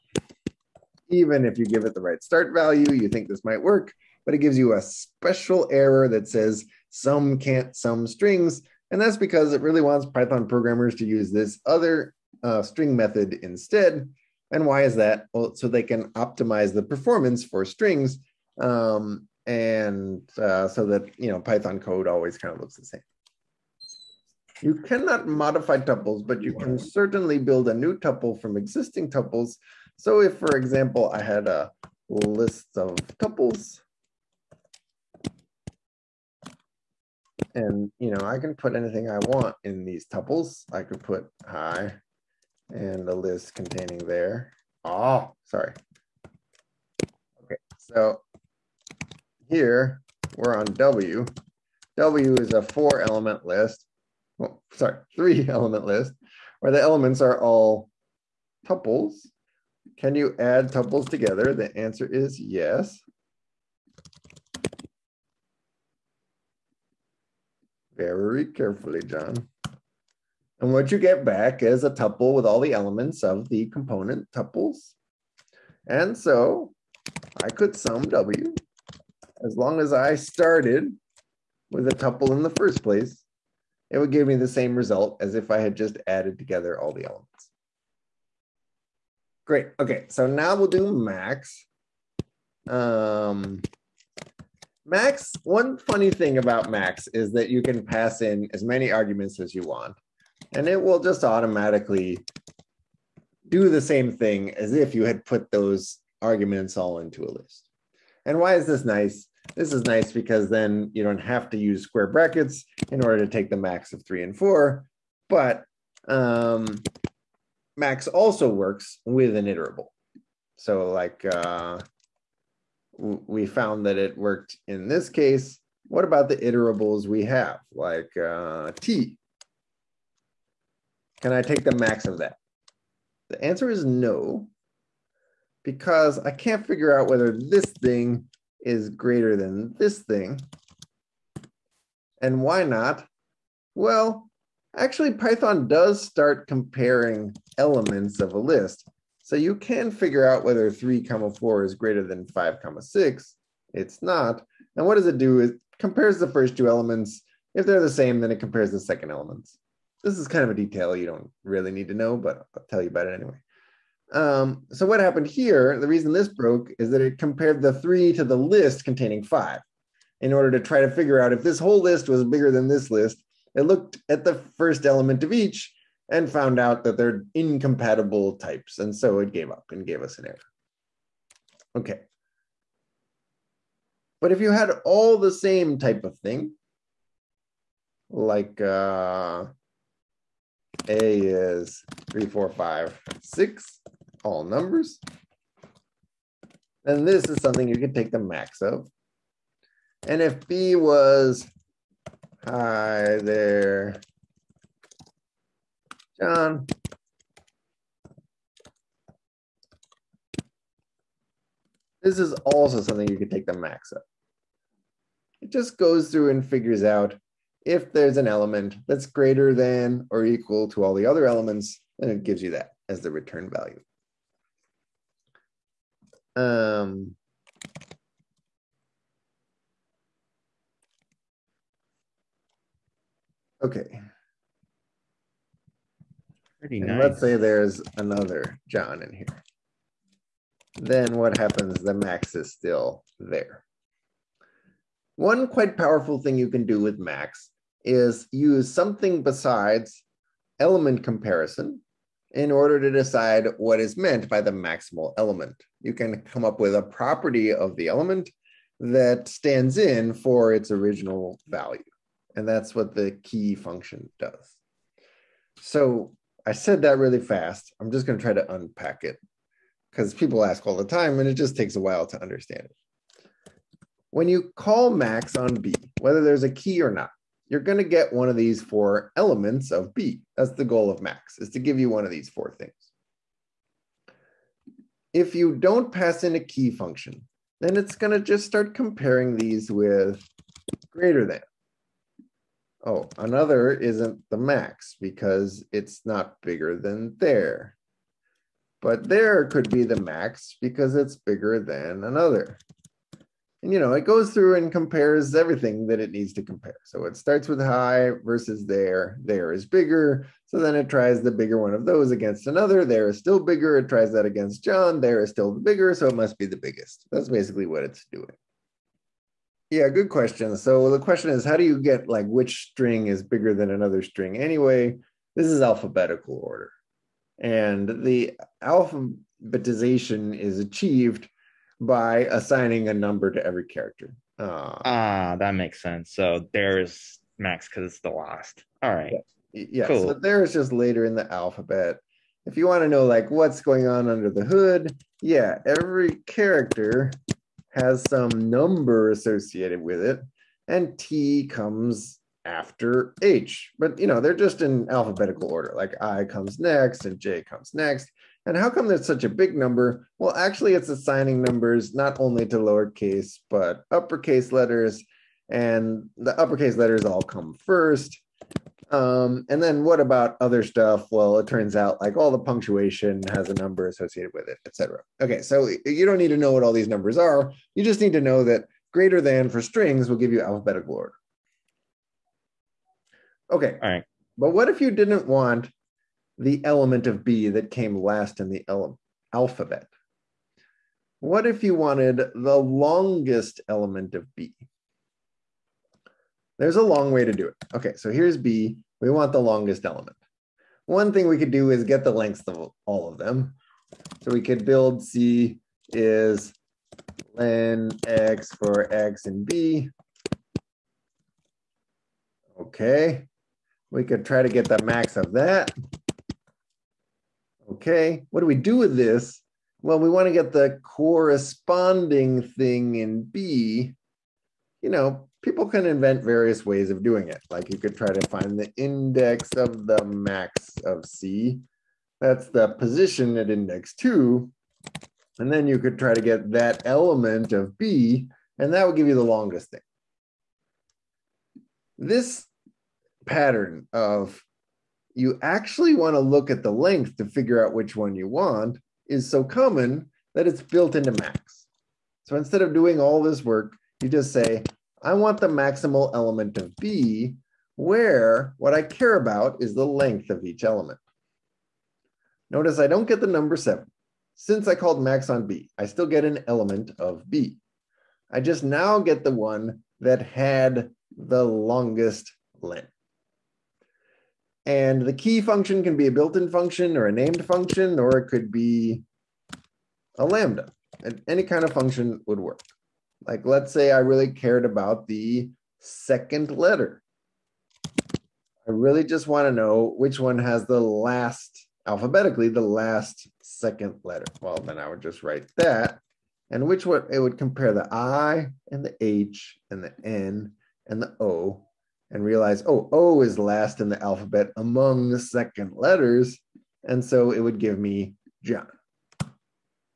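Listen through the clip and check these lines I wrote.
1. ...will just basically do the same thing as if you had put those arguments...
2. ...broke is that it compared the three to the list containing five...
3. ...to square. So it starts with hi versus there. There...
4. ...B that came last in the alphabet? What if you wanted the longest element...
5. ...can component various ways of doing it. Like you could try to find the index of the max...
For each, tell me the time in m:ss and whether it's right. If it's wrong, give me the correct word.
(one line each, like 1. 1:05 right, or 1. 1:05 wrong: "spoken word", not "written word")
1. 1:40 wrong: "automatically", not "basically"
2. 2:46 right
3. 5:06 wrong: "compare", not "square"
4. 6:27 right
5. 7:05 wrong: "invent", not "component".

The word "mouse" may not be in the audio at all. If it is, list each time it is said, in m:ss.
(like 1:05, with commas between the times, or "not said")
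not said.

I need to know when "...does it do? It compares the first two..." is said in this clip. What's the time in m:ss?
2:34.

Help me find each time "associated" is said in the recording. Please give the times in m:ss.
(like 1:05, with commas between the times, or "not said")
5:49, 6:13.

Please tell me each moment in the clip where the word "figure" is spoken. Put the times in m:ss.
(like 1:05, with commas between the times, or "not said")
2:16, 2:29, 2:50, 3:36, 7:27.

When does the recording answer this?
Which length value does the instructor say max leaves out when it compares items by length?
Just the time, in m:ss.
7:43.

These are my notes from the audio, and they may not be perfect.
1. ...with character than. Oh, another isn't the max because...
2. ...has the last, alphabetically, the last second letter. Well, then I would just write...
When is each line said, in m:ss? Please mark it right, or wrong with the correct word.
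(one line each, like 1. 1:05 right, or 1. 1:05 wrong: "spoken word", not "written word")
1. 4:49 wrong: "greater", not "character"
2. 8:10 right.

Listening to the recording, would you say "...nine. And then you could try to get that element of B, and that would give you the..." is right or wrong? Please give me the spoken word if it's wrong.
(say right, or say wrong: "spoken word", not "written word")
wrong: "two", not "nine".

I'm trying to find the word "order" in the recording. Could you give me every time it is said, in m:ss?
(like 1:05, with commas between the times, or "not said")
1:53, 2:50, 4:12, 5:26, 5:55, 6:20.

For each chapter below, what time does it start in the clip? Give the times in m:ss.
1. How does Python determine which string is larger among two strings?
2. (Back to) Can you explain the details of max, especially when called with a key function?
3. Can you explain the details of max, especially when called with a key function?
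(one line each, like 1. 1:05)
1. 5:18
2. 6:22
3. 1:28.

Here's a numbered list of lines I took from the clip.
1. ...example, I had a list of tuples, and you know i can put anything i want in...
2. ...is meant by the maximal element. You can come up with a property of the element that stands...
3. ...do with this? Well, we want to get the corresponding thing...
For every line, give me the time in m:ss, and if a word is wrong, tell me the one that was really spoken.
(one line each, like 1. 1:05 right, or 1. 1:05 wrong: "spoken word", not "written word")
1. 0:30 right
2. 4:13 right
3. 6:58 right.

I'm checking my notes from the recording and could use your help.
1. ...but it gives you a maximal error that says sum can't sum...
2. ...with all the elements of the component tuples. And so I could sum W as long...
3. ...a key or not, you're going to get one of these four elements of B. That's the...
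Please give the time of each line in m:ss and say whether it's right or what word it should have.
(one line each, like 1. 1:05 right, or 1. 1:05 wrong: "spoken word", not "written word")
1. 0:04 wrong: "special", not "maximal"
2. 1:12 right
3. 4:36 right.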